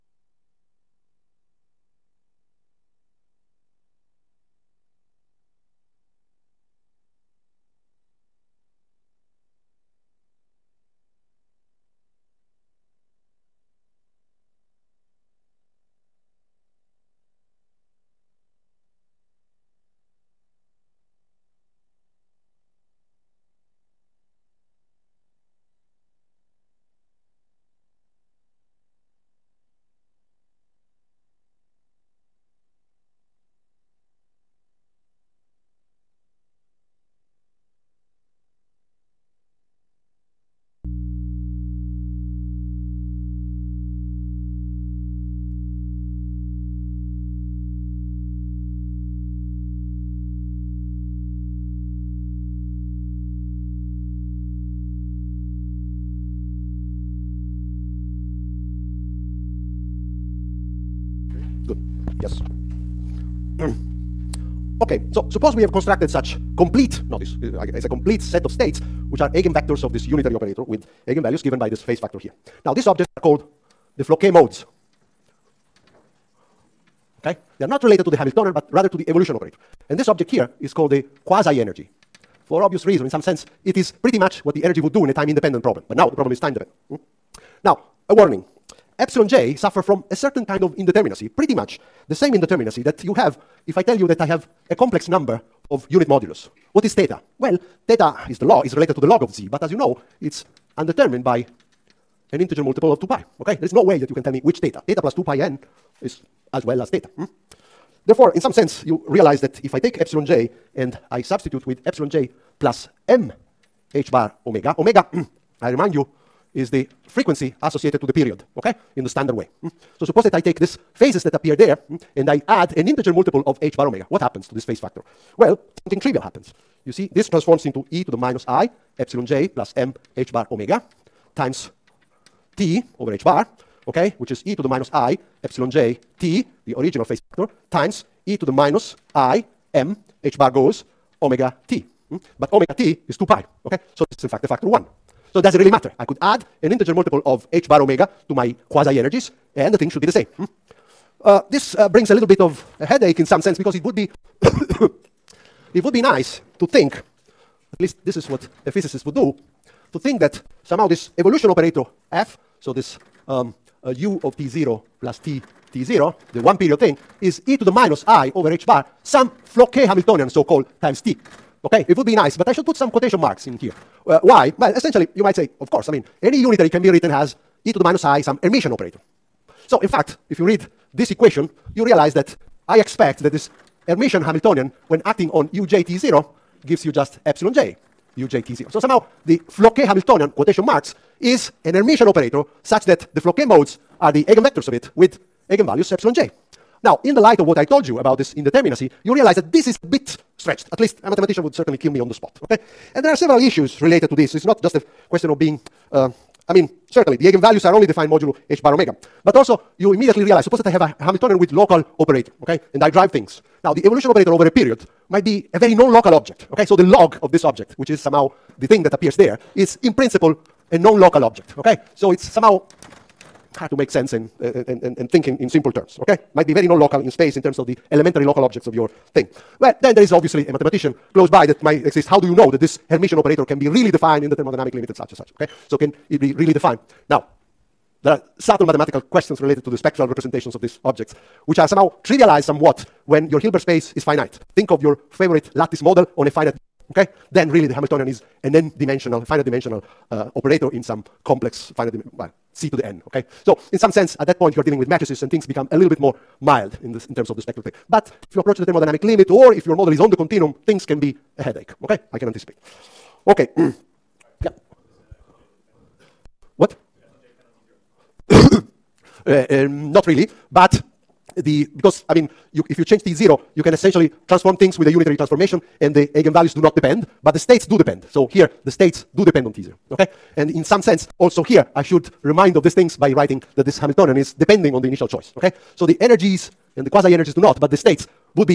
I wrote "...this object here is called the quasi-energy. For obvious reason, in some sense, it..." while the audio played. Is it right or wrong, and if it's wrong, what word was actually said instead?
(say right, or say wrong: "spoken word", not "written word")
right.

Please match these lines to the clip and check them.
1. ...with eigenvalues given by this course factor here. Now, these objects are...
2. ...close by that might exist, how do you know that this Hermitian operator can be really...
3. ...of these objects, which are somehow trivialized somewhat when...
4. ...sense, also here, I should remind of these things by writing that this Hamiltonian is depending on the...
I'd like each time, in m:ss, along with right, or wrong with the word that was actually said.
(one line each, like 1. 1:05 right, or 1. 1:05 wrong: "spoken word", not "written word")
1. 1:10 wrong: "phase", not "course"
2. 3:51 right
3. 4:00 right
4. 4:40 right.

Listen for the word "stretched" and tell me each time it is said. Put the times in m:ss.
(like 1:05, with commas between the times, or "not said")
3:20.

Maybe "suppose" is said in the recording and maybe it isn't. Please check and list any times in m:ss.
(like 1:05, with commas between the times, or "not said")
1:05, 2:00, 3:30.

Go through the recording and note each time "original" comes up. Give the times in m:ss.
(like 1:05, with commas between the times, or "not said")
2:16.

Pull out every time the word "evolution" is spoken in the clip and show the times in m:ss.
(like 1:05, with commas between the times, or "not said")
1:19, 2:41, 3:33.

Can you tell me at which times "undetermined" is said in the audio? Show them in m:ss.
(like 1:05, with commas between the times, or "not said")
1:40.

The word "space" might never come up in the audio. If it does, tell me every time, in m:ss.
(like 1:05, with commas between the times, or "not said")
3:47, 4:03.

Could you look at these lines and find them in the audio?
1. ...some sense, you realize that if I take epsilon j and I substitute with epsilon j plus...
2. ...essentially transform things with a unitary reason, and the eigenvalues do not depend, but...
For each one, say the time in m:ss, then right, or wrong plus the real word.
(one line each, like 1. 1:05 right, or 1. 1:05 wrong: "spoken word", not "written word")
1. 1:48 right
2. 4:33 wrong: "transformation", not "reason".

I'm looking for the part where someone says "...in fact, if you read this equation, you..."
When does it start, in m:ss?
2:59.